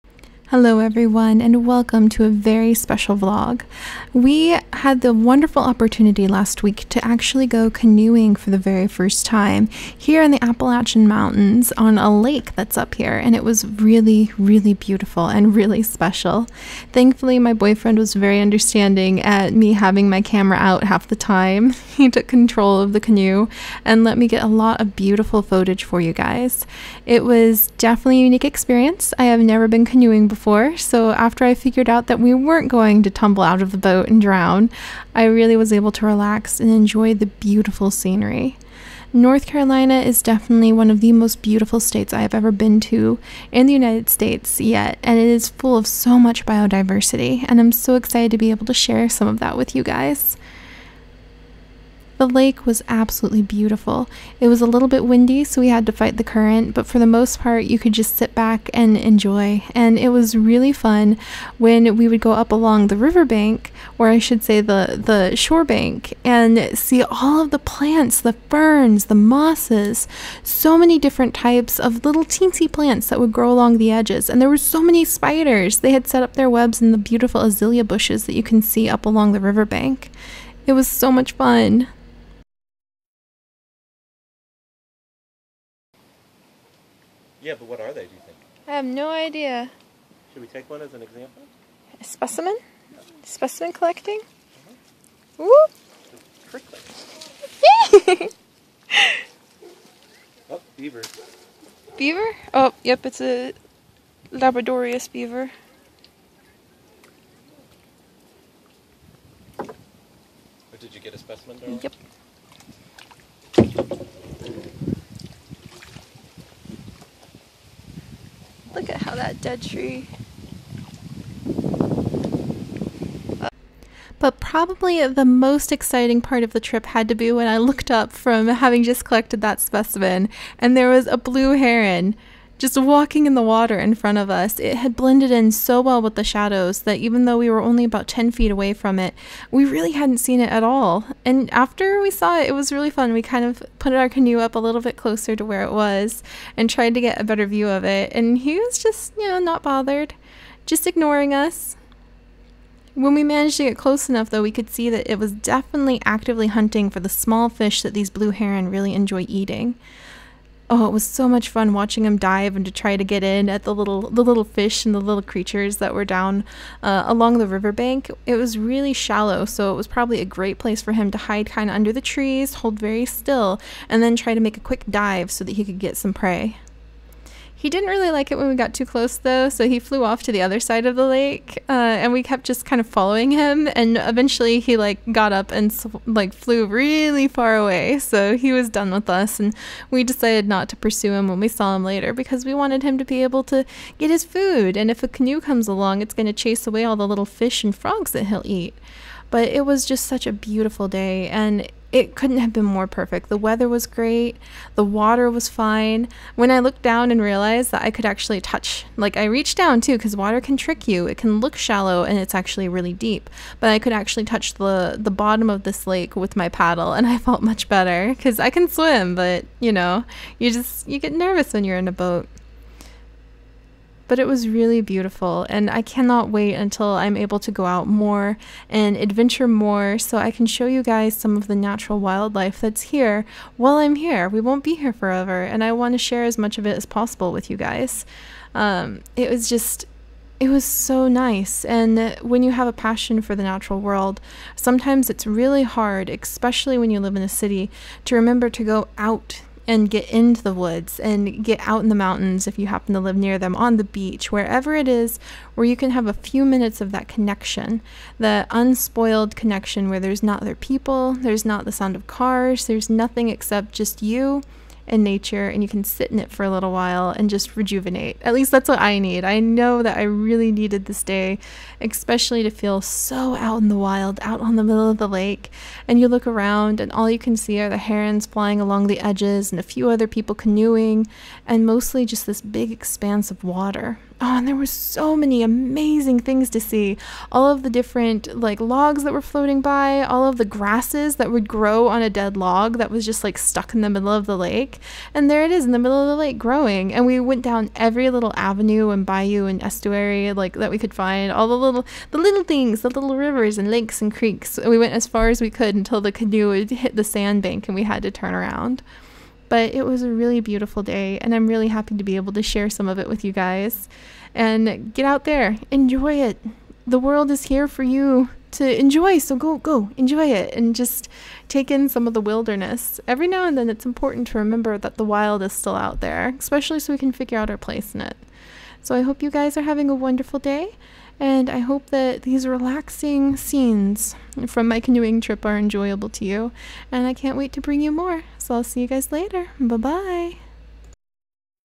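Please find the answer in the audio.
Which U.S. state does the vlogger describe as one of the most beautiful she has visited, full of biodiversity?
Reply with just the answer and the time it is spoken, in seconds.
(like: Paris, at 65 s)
North Carolina, at 39 s.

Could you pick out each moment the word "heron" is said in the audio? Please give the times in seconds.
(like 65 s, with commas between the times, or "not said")
131 s, 158 s, 277 s.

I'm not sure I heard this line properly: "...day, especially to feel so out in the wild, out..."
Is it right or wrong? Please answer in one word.
right.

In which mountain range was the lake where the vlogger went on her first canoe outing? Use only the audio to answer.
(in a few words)
Appalachian Mountains.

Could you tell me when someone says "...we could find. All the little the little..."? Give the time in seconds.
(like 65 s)
300 s.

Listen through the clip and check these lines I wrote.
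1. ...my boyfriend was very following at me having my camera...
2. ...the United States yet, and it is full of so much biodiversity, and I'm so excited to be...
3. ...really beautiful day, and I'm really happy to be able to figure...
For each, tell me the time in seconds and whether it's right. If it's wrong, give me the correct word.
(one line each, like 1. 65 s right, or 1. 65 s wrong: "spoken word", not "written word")
1. 17 s wrong: "understanding", not "following"
2. 43 s right
3. 310 s wrong: "share", not "figure".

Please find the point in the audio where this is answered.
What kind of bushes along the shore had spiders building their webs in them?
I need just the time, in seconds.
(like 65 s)
77 s.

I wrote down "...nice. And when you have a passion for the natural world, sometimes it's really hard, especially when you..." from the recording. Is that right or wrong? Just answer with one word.
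right.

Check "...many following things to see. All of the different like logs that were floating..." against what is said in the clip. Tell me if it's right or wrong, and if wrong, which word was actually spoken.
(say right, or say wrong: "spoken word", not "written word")
wrong: "amazing", not "following".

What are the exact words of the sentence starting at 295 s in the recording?
And there it is in the middle of the lake growing.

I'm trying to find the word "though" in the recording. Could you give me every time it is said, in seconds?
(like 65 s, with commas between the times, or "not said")
137 s, 154 s, 179 s.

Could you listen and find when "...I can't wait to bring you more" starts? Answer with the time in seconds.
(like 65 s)
337 s.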